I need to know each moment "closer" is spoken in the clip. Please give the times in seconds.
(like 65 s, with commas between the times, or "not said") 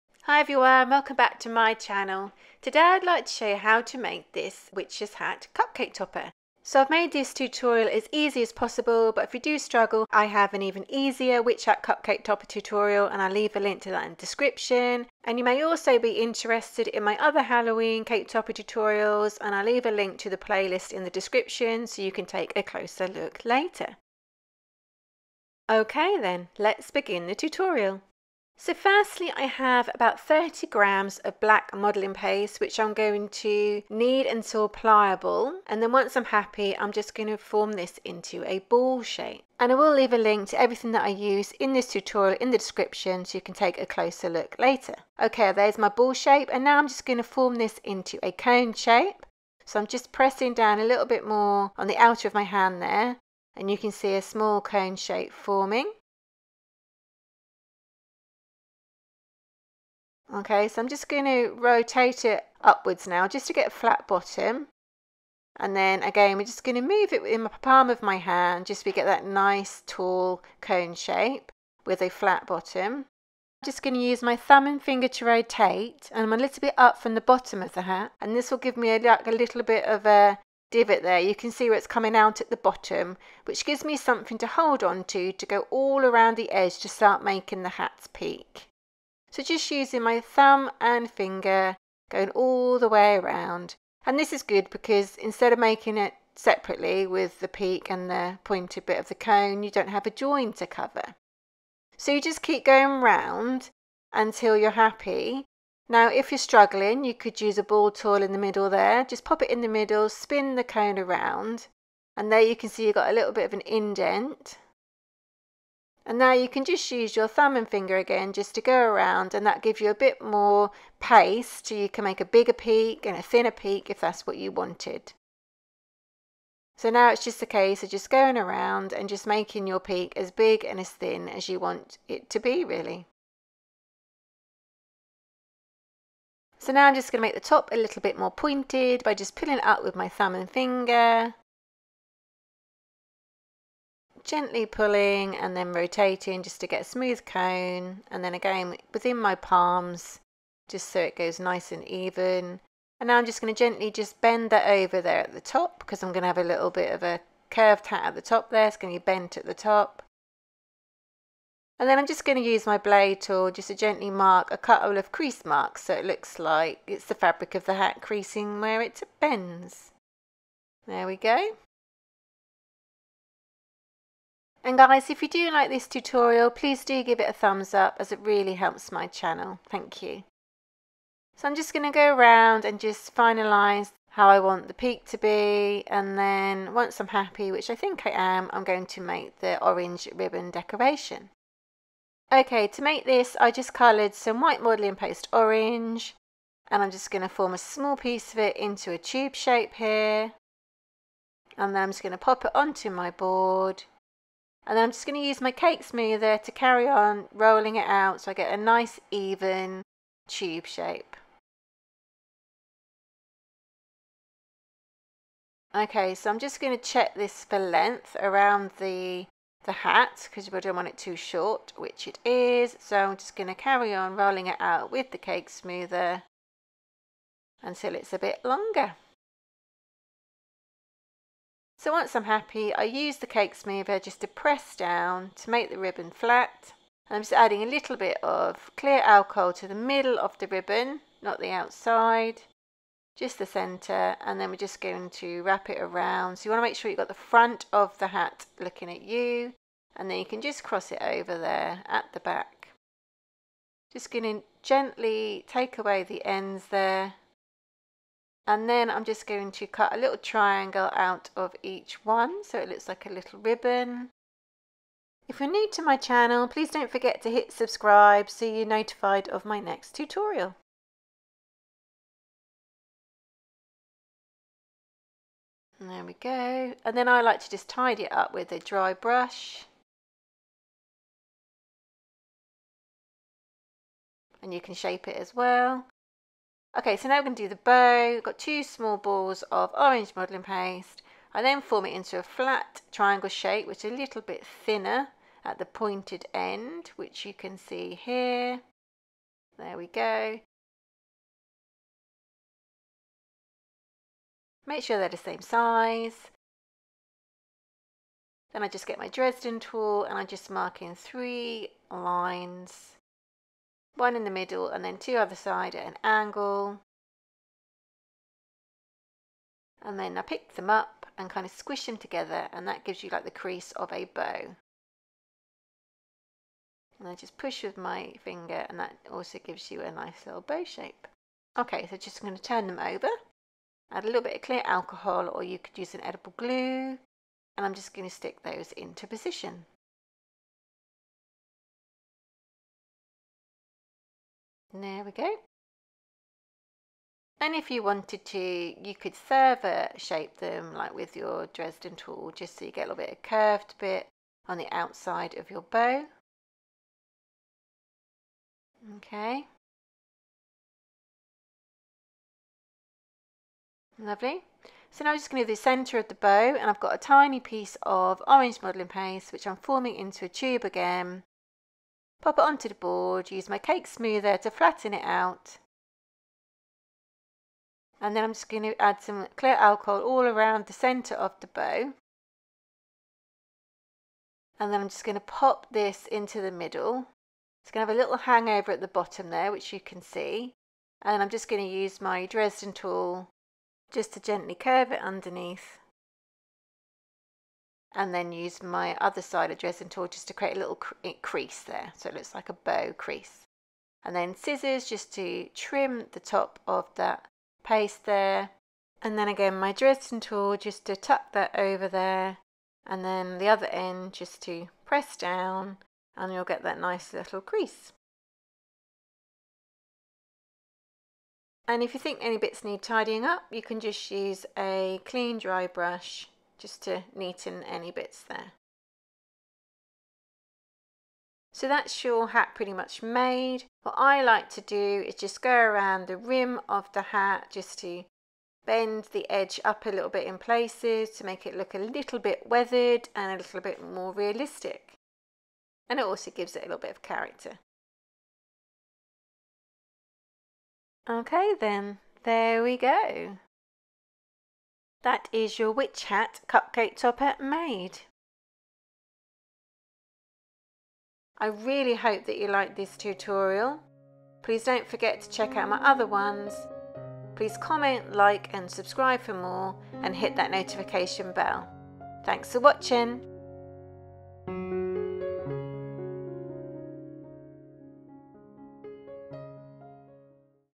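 22 s, 43 s.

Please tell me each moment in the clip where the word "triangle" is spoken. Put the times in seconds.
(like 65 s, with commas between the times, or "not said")
260 s, 292 s.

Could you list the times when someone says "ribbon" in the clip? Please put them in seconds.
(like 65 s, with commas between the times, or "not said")
190 s, 235 s, 240 s, 263 s.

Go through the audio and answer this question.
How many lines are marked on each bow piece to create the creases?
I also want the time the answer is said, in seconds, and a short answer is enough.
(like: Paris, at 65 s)
3, at 310 s.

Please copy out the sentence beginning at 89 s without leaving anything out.
So just using my thumb and finger, going all the way around.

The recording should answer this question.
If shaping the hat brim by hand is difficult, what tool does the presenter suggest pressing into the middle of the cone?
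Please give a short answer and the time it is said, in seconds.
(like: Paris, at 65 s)
ball tool, at 107 s.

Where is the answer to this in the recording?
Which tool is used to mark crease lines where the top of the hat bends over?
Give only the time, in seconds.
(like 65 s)
162 s.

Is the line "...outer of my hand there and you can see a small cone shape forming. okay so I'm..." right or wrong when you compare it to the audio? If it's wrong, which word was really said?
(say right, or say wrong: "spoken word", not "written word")
right.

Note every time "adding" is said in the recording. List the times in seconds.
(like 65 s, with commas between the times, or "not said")
237 s.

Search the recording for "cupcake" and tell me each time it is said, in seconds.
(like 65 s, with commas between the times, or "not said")
5 s, 11 s, 456 s.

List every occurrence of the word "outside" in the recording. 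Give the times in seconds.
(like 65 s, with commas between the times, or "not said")
241 s, 354 s.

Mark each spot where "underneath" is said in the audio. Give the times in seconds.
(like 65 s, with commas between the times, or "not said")
395 s.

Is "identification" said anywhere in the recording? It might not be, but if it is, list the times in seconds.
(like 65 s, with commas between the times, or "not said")
not said.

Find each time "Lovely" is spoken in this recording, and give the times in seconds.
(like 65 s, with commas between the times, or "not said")
363 s.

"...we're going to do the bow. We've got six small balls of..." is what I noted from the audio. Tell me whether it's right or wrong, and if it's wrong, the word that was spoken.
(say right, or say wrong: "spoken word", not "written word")
wrong: "two", not "six".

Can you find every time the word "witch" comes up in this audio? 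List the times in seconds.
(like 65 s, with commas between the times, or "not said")
4 s, 11 s, 455 s.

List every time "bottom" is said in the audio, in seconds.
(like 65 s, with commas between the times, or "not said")
64 s, 72 s, 77 s, 82 s, 388 s.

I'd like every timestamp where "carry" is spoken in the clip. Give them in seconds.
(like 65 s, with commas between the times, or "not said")
206 s, 223 s.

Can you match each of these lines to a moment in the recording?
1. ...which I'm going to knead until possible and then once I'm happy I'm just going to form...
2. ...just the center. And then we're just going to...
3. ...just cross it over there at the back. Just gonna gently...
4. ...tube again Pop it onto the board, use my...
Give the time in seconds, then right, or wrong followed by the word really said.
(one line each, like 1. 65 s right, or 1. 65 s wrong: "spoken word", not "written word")
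1. 32 s wrong: "pliable", not "possible"
2. 243 s right
3. 250 s right
4. 370 s right.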